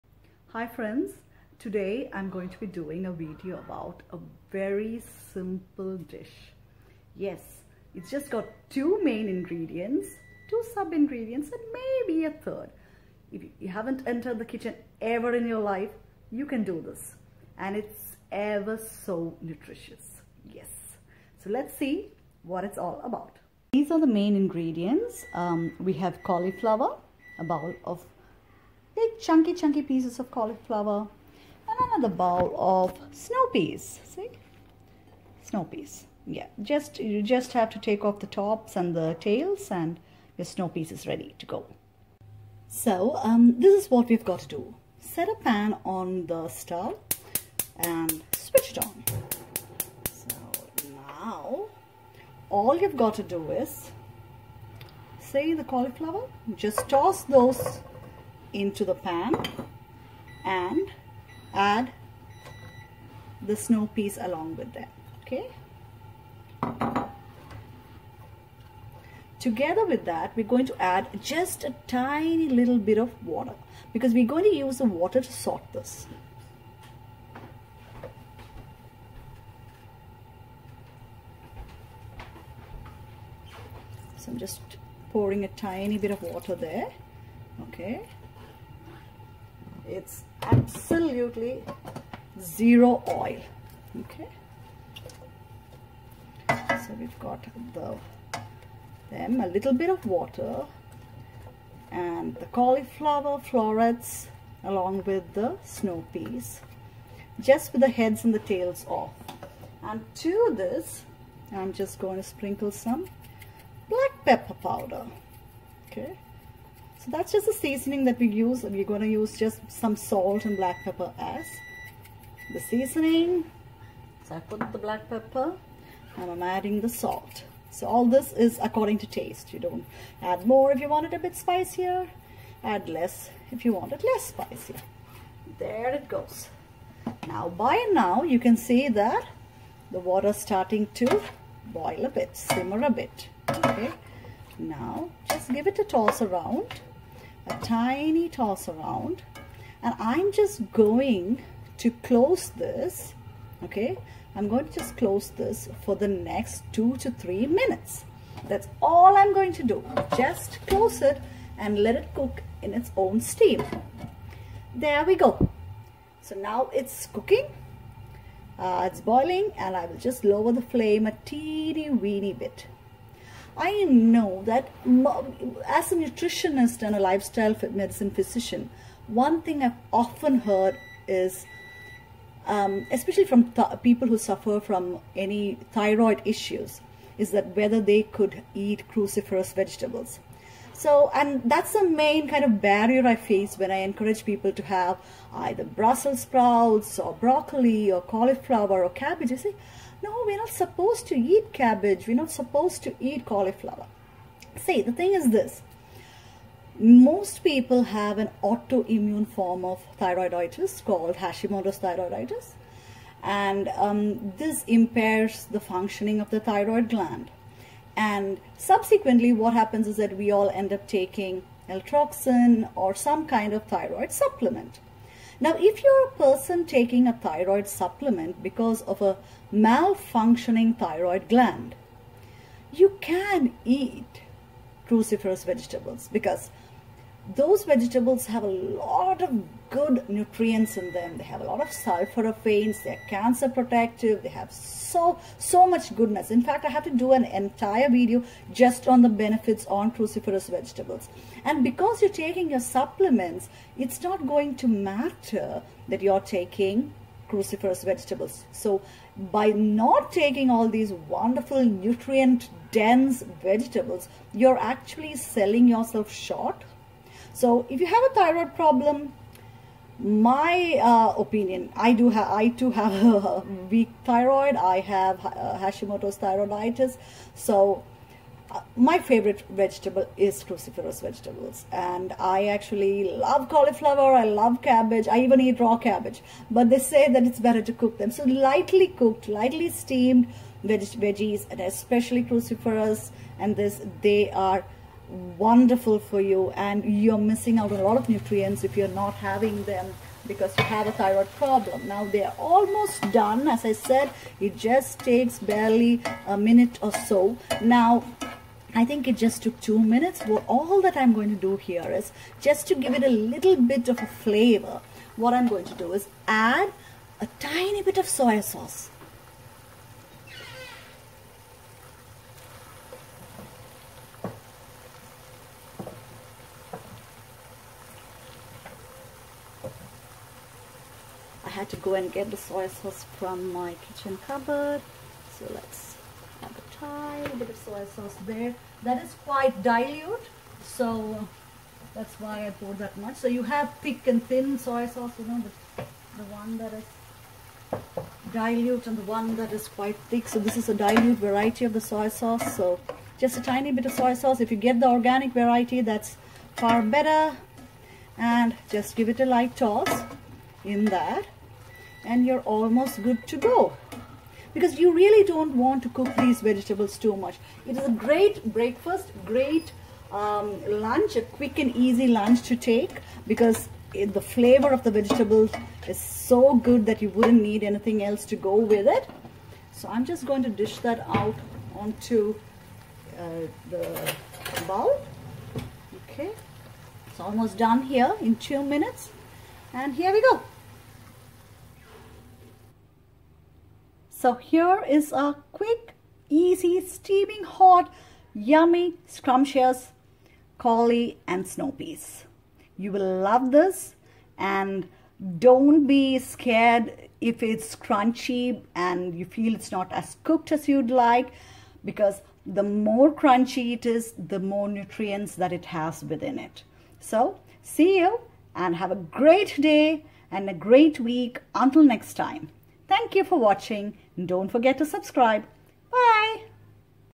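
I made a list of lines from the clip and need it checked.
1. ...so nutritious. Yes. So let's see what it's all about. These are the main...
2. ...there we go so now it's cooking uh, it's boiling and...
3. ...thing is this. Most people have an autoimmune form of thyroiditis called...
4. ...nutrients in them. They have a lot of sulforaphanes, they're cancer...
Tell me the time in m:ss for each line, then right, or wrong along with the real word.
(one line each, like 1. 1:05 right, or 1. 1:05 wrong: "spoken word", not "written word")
1. 0:18 right
2. 2:44 right
3. 3:24 right
4. 4:00 right.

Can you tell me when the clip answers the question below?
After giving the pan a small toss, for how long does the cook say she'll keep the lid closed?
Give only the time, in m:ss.
2:36.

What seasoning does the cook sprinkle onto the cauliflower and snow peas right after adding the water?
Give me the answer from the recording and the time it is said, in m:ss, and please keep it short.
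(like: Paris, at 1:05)
black pepper powder, at 1:53.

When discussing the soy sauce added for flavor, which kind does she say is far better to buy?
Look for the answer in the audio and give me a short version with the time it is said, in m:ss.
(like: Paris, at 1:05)
organic, at 5:54.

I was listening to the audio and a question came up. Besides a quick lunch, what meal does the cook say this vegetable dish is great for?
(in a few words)
breakfast.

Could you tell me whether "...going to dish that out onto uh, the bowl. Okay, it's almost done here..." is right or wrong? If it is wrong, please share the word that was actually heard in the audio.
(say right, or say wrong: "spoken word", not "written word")
right.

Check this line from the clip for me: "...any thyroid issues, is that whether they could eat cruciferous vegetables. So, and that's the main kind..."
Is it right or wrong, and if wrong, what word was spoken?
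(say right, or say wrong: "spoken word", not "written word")
right.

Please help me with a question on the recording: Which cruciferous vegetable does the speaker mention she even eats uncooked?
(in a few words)
raw cabbage.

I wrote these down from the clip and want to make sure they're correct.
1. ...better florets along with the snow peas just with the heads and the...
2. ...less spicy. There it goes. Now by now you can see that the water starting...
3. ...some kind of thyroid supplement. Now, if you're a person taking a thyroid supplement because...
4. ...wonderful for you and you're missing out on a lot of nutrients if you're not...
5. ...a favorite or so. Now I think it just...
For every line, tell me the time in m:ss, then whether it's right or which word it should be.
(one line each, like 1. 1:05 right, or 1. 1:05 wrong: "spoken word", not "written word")
1. 1:42 wrong: "cauliflower", not "better"
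2. 2:14 right
3. 3:42 right
4. 4:55 right
5. 5:06 wrong: "minute", not "favorite".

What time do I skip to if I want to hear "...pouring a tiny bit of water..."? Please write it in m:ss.
1:25.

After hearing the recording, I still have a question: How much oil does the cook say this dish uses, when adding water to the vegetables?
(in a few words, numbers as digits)
zero.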